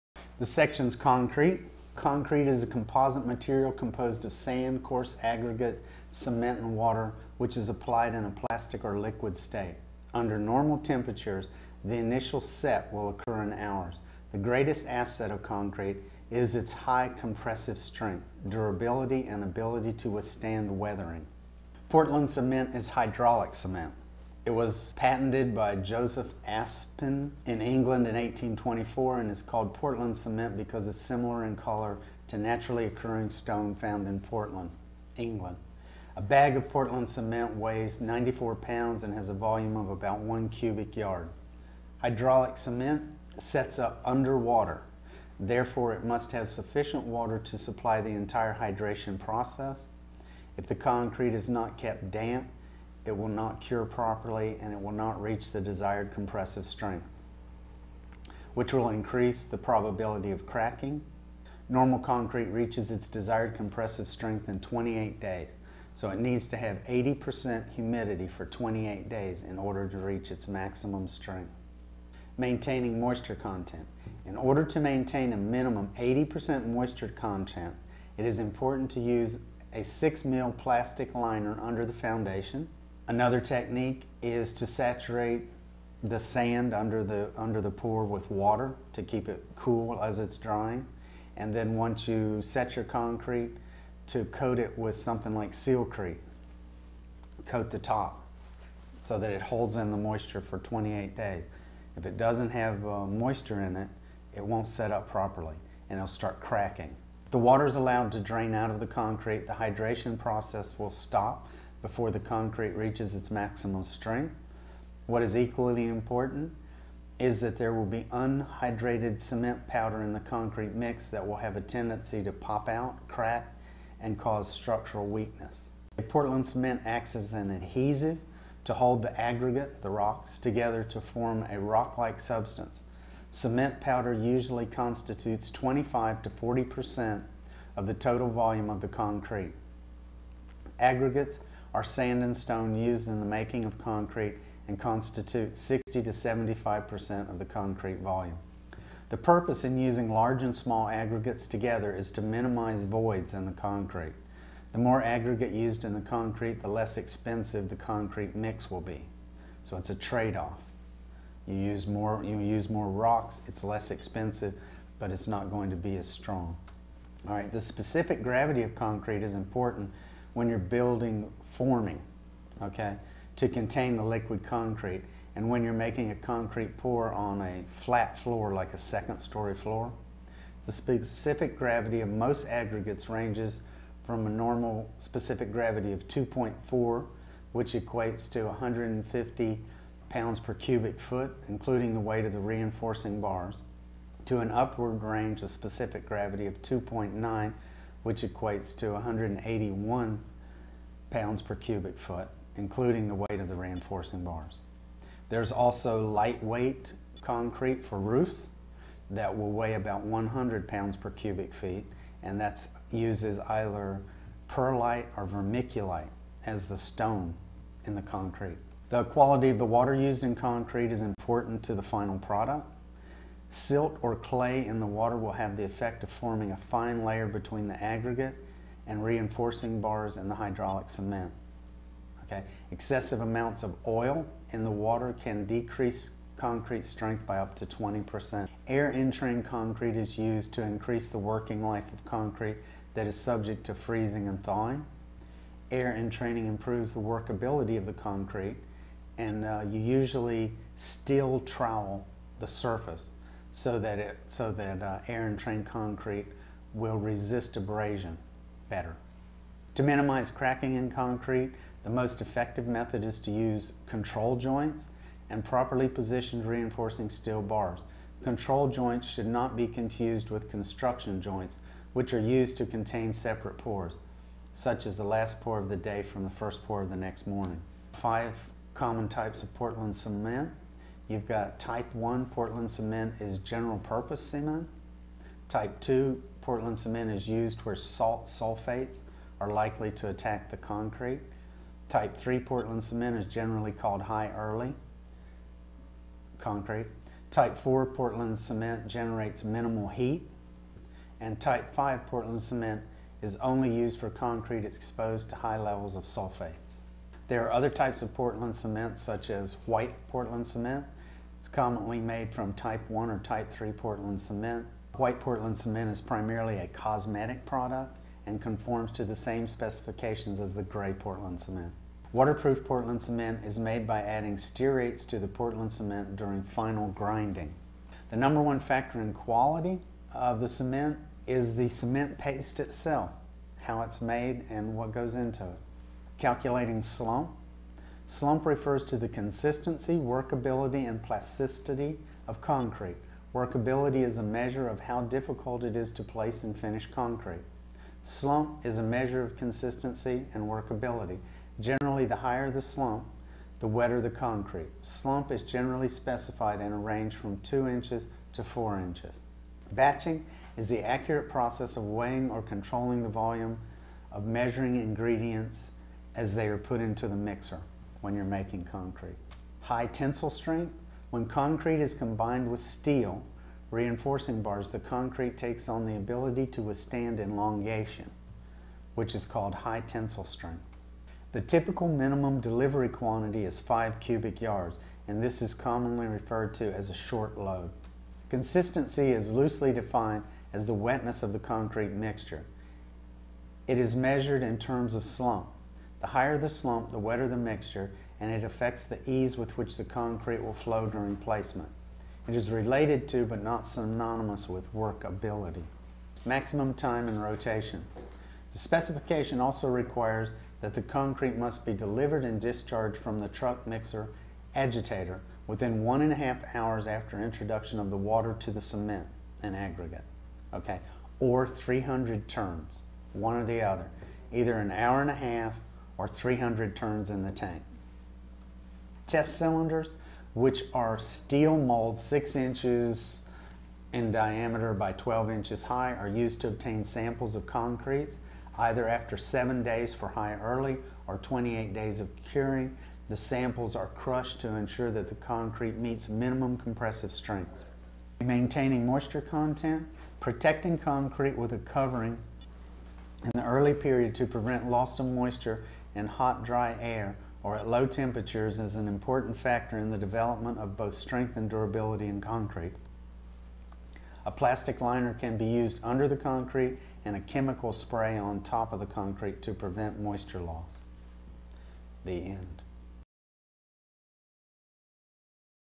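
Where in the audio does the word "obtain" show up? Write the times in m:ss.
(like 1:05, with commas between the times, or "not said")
7:16.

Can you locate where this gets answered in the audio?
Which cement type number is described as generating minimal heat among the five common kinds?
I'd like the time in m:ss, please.
4:57.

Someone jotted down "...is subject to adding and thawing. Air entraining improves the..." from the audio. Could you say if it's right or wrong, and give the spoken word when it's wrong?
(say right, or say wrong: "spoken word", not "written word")
wrong: "freezing", not "adding".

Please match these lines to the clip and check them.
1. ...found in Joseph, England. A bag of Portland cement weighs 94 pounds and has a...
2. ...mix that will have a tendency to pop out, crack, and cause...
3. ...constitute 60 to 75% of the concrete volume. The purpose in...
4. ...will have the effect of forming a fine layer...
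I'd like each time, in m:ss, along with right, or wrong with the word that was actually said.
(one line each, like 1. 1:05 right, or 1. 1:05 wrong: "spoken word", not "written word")
1. 0:33 wrong: "Portland", not "Joseph"
2. 2:00 right
3. 2:24 right
4. 3:45 right.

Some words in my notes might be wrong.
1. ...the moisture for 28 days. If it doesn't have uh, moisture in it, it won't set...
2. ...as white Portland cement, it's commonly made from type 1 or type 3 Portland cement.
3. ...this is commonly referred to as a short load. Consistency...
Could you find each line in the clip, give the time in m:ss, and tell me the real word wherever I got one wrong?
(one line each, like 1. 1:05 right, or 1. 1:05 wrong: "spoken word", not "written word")
1. 1:39 right
2. 5:09 right
3. 6:25 right.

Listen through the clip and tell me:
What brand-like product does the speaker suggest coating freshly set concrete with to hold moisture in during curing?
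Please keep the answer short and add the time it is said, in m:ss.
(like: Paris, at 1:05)
Sealcrete, at 1:35.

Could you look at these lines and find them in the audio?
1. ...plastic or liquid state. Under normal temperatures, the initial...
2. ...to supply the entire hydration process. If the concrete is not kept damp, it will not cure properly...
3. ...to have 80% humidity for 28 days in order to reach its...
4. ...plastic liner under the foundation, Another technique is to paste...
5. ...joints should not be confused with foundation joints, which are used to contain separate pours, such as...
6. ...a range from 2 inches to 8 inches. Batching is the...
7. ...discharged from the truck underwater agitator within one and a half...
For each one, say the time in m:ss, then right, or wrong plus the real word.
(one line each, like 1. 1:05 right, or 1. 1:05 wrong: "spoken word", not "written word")
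1. 0:08 right
2. 0:47 right
3. 1:06 right
4. 1:20 wrong: "saturate", not "paste"
5. 4:28 wrong: "construction", not "foundation"
6. 5:56 wrong: "4", not "8"
7. 6:52 wrong: "mixer", not "underwater".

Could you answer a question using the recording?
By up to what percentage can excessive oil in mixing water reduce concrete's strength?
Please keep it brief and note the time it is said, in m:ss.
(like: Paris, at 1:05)
20%, at 3:57.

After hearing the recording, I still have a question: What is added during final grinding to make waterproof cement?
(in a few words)
stearates.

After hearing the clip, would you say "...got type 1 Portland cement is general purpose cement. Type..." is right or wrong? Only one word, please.
right.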